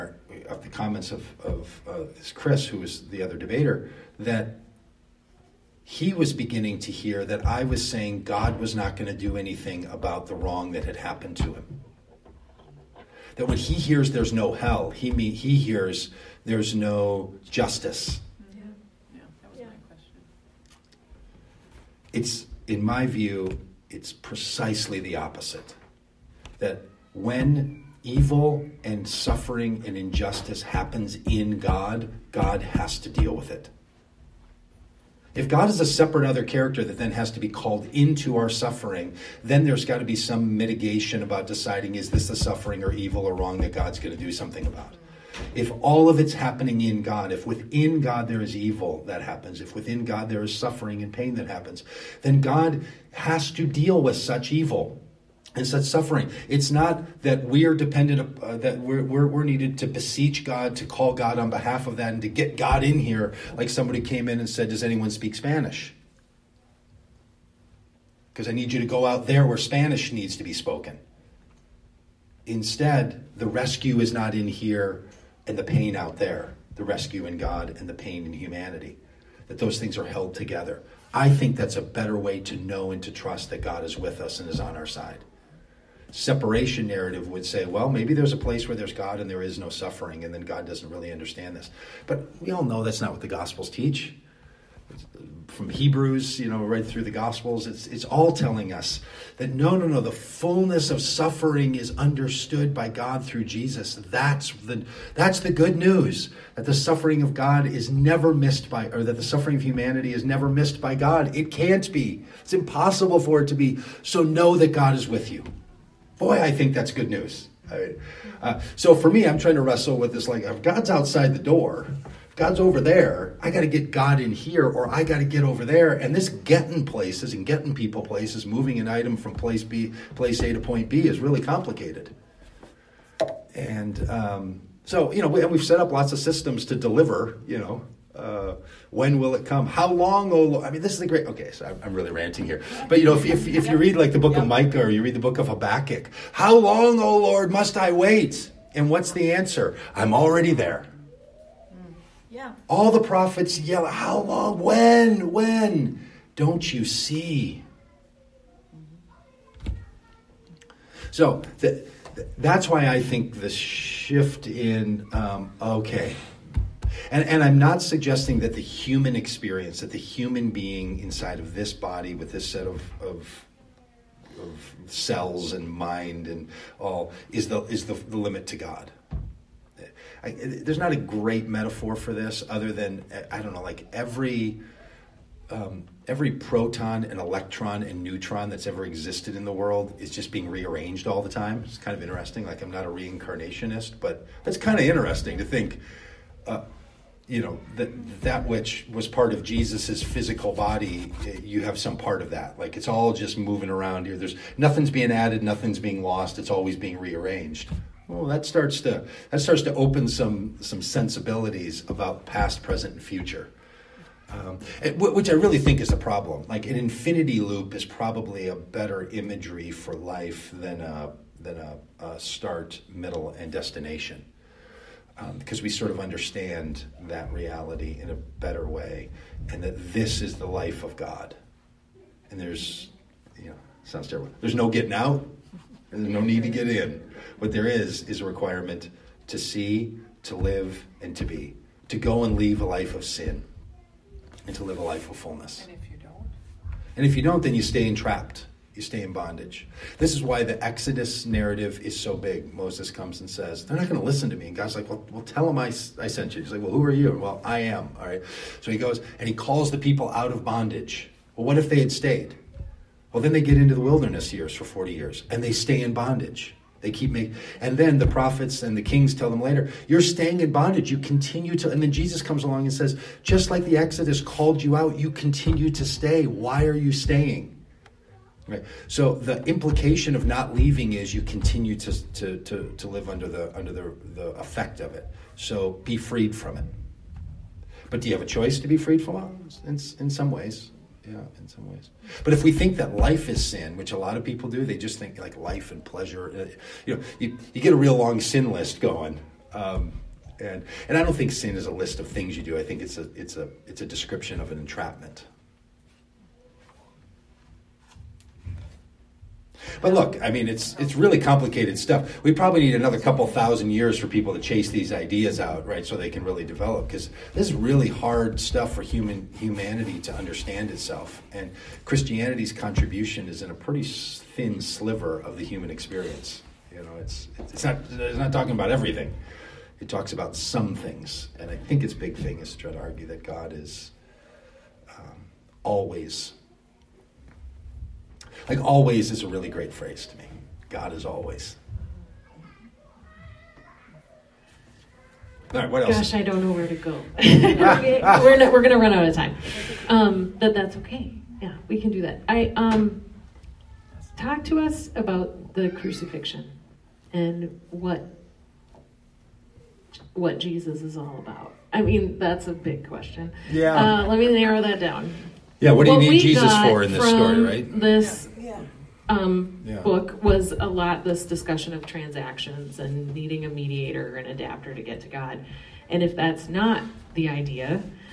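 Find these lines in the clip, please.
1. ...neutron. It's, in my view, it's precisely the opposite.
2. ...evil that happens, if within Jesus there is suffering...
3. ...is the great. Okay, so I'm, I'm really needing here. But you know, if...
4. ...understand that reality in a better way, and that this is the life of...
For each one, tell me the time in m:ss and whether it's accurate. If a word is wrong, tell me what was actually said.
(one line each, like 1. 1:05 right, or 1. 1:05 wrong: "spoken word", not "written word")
1. 0:19 wrong: "question", not "neutron"
2. 0:48 wrong: "God", not "Jesus"
3. 2:20 wrong: "ranting", not "needing"
4. 3:45 right.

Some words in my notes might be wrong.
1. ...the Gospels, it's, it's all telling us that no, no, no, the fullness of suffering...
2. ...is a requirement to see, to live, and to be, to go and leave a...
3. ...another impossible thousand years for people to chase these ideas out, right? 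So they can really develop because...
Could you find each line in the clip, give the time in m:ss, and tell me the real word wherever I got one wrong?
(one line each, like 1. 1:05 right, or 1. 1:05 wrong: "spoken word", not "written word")
1. 1:37 right
2. 3:58 right
3. 5:12 wrong: "couple", not "impossible".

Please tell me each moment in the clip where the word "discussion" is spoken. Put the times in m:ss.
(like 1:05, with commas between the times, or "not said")
6:11.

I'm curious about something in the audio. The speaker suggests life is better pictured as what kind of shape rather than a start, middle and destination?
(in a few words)
An infinity loop.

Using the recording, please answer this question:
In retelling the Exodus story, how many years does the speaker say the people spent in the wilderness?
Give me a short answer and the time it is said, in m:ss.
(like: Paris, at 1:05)
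40, at 4:24.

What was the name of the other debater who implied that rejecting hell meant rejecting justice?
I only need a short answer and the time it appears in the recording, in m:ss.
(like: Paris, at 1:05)
Chris, at 0:02.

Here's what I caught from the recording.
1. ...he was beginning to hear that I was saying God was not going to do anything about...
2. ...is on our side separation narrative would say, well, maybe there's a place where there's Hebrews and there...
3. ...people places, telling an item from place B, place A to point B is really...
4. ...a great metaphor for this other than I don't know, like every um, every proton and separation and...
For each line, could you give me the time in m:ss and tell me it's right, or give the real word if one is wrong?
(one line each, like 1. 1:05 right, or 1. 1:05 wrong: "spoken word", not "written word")
1. 0:05 right
2. 1:24 wrong: "God", not "Hebrews"
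3. 2:07 wrong: "moving", not "telling"
4. 3:00 wrong: "electron", not "separation".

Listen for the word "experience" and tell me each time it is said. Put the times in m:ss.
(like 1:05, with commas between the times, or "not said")
2:49, 5:25.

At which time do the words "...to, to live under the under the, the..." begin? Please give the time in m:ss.
4:42.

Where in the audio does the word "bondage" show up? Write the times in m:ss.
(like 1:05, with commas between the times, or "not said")
4:09, 4:20, 4:25, 4:30.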